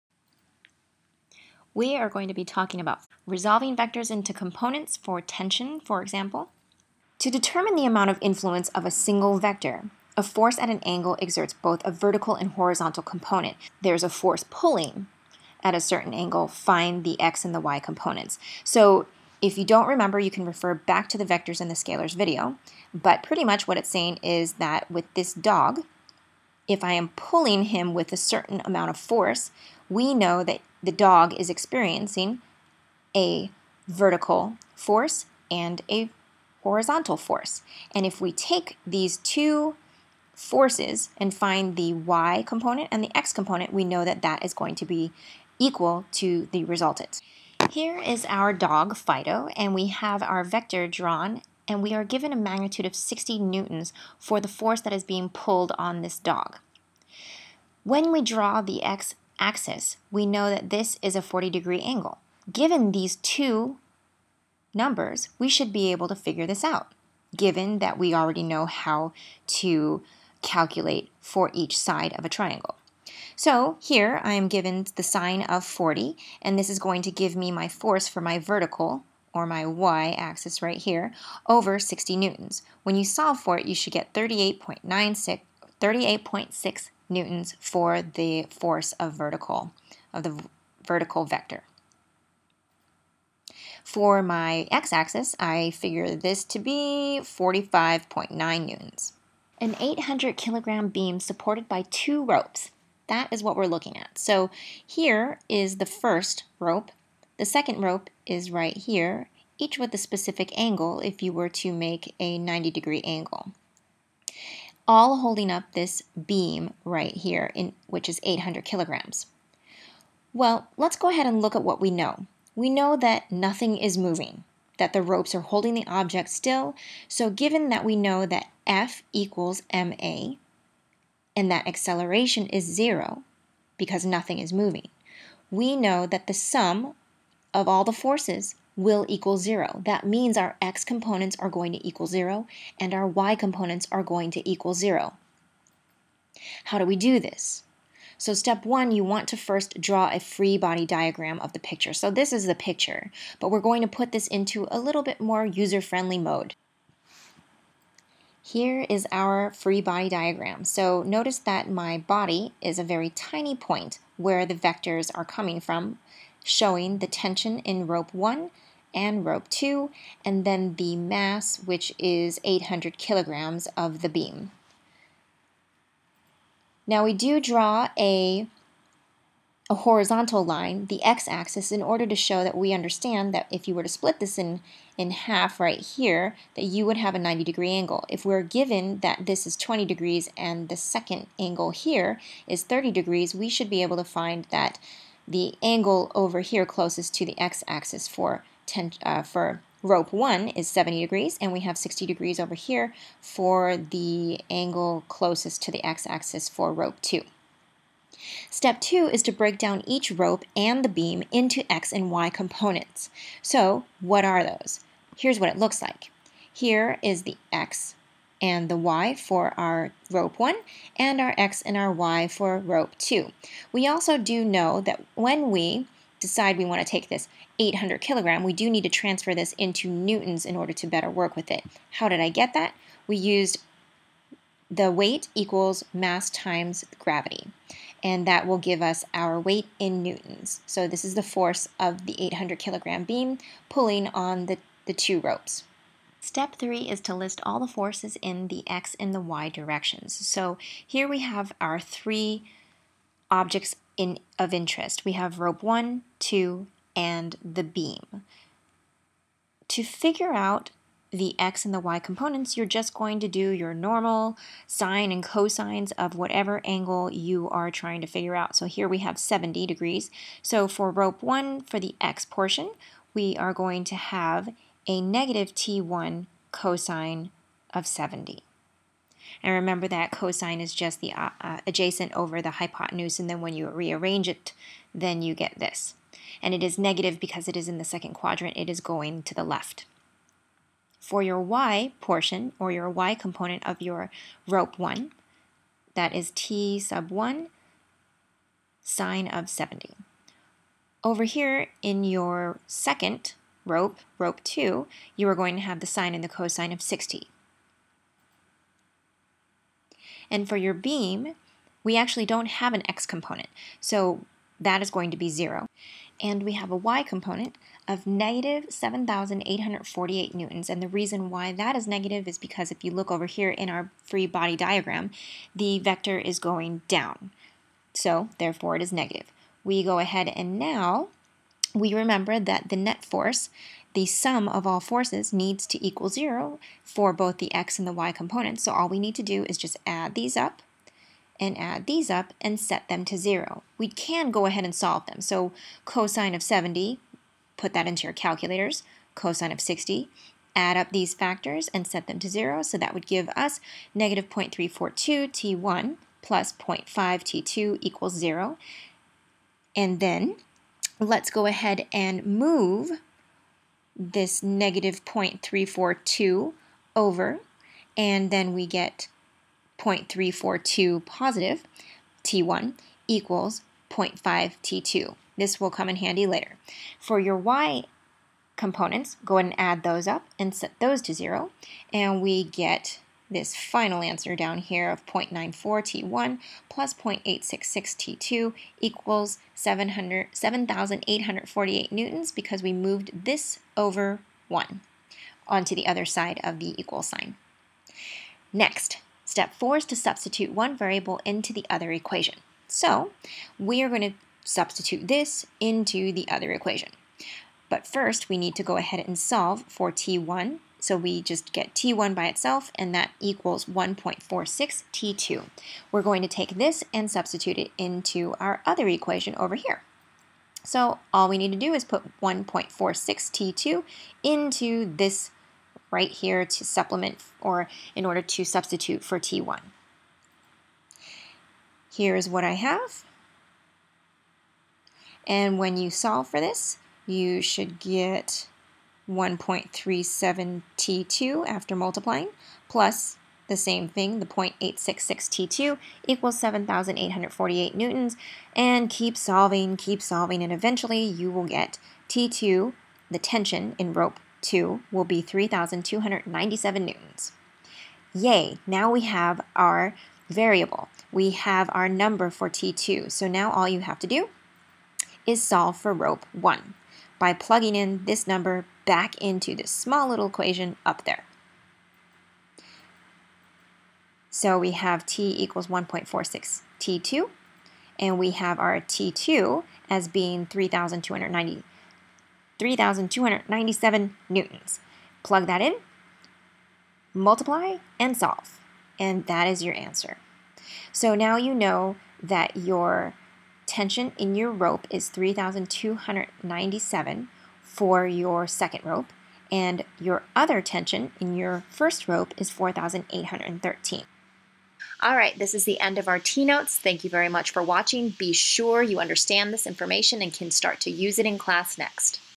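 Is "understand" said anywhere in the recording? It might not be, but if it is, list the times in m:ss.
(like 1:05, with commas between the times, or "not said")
3:02, 8:28.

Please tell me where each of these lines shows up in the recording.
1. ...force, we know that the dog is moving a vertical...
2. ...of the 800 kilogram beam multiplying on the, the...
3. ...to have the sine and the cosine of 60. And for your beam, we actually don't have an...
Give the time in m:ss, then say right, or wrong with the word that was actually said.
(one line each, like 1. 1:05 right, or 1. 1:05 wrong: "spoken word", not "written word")
1. 0:28 wrong: "experiencing", not "moving"
2. 4:01 wrong: "pulling", not "multiplying"
3. 5:05 right.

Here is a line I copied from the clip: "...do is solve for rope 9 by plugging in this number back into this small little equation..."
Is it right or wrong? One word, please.
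wrong.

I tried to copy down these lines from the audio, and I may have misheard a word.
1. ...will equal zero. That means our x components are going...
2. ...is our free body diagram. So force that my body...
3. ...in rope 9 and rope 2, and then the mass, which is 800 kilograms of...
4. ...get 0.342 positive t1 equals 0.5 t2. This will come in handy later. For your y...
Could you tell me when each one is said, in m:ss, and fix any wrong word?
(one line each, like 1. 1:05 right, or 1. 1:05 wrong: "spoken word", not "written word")
1. 2:18 right
2. 2:38 wrong: "notice", not "force"
3. 2:47 wrong: "1", not "9"
4. 6:08 right.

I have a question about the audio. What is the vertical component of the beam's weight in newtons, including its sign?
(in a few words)
-7,848 newtons.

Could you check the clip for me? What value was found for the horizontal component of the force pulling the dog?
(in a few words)
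45.9 newtons.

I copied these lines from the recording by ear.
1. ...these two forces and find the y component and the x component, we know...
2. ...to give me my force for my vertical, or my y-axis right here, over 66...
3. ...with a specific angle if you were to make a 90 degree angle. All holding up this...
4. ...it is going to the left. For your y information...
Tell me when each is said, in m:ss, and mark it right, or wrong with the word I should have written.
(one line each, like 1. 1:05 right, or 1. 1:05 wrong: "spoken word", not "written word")
1. 0:38 right
2. 1:17 wrong: "60", not "66"
3. 1:49 right
4. 4:48 wrong: "portion", not "information".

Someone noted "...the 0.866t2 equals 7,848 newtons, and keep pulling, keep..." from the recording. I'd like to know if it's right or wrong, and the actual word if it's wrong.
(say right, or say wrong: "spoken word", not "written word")
wrong: "solving", not "pulling".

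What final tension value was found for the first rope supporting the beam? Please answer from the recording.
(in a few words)
4,813.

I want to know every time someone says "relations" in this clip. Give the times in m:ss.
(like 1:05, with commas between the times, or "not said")
not said.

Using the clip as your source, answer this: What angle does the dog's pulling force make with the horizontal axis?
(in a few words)
40 degrees.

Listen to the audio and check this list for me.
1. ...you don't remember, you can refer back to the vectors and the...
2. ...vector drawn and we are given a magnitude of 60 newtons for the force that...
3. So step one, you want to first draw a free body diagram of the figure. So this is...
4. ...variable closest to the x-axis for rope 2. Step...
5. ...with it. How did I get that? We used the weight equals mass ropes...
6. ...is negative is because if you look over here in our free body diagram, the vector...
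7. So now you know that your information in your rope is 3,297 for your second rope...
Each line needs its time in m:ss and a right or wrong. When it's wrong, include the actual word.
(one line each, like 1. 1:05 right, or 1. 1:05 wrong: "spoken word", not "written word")
1. 0:19 right
2. 0:50 right
3. 2:28 wrong: "picture", not "figure"
4. 3:24 wrong: "angle", not "variable"
5. 3:51 wrong: "times", not "ropes"
6. 5:21 right
7. 8:10 wrong: "tension", not "information".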